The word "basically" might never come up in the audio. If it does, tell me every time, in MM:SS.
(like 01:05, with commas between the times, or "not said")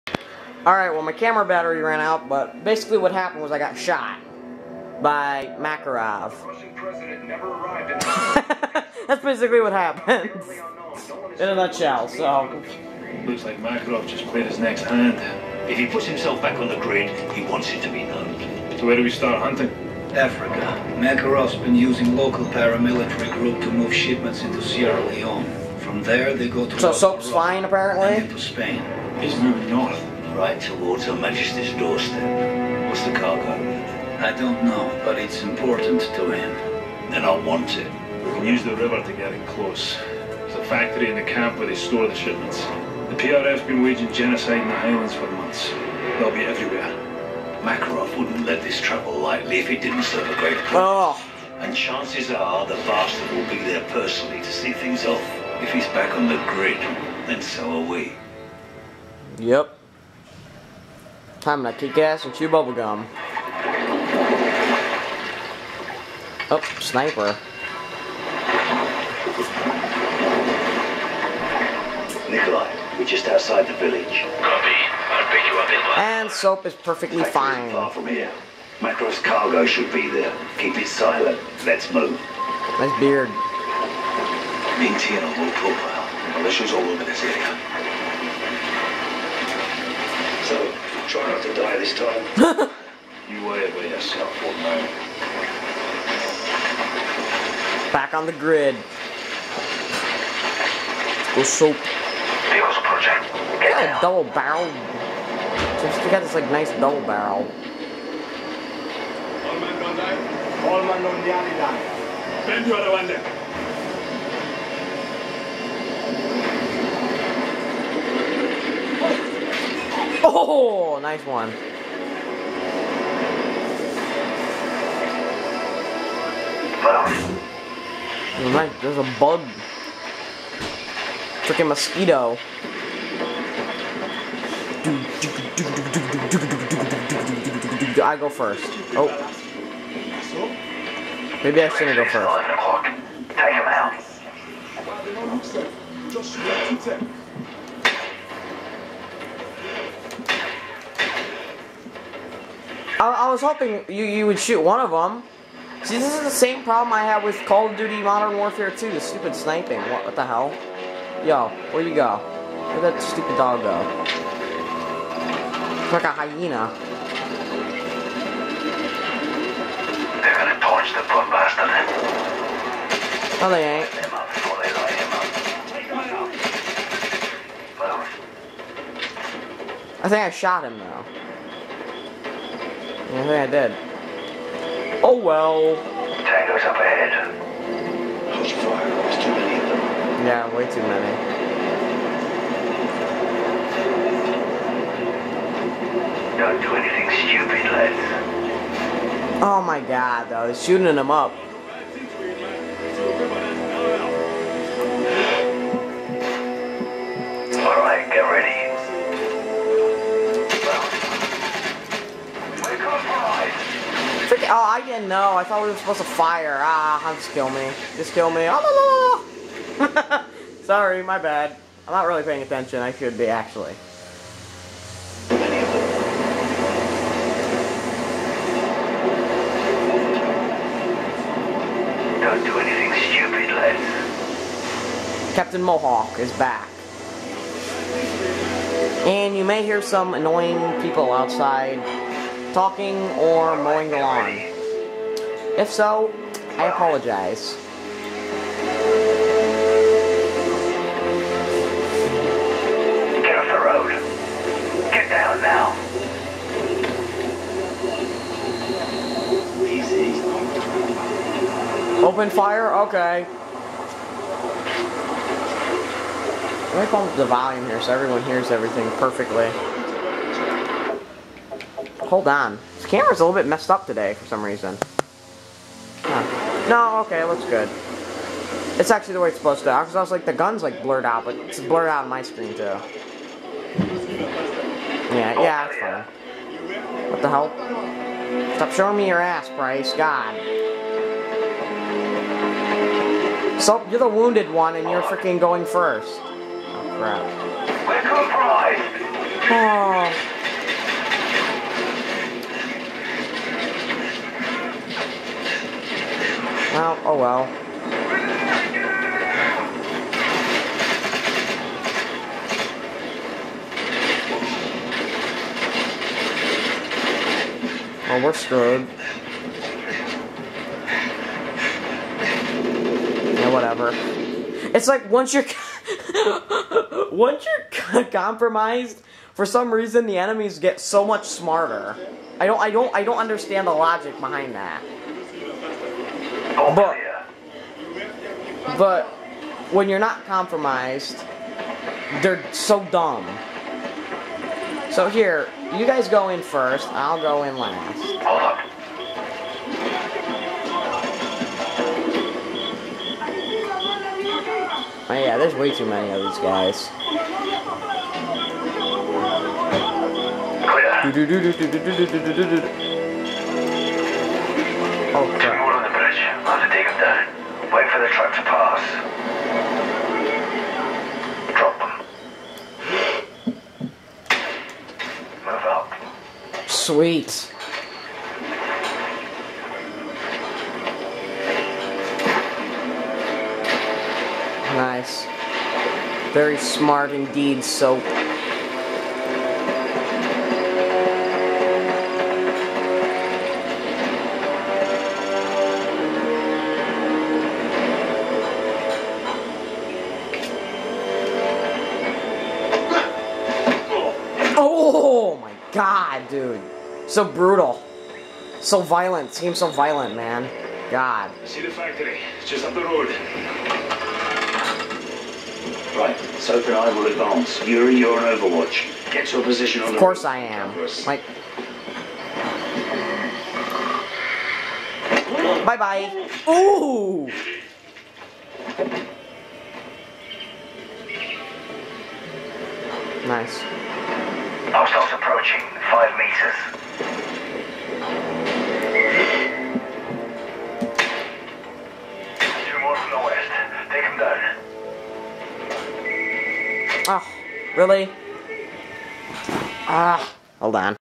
00:02, 00:09.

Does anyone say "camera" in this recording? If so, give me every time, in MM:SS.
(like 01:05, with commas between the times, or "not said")
00:01, 04:32.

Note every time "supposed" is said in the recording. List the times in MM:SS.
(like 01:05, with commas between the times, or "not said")
03:35, 04:39.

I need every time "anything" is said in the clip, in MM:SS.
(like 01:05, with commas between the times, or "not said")
03:16, 03:52.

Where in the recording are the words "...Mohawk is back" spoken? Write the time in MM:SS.
03:55.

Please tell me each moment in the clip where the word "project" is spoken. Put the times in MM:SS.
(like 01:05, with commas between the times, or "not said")
01:42.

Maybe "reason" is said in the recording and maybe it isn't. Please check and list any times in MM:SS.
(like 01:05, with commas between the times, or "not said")
04:34, 05:29.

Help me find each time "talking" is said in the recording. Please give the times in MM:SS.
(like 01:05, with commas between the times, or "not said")
04:02.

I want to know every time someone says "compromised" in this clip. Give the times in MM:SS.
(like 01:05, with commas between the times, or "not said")
05:28, 05:40.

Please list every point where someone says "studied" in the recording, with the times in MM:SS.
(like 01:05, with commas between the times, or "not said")
not said.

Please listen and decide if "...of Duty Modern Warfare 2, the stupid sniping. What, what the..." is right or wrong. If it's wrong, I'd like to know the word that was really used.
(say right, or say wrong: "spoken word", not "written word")
right.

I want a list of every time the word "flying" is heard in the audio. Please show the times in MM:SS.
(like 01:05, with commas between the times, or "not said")
00:27.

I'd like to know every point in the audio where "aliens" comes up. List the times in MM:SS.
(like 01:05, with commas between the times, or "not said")
not said.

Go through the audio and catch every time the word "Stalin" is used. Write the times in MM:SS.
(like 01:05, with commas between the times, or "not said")
not said.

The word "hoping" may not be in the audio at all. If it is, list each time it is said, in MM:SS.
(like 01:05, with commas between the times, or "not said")
02:33.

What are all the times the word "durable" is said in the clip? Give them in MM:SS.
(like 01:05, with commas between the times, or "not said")
not said.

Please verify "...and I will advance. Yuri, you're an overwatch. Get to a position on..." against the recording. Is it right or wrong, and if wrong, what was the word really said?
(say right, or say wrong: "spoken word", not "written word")
right.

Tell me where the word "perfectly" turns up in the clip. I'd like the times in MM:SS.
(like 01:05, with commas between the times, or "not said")
01:16, 04:28.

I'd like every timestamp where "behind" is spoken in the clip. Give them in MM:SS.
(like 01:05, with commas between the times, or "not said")
05:34.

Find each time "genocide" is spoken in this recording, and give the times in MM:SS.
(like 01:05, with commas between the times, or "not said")
00:44.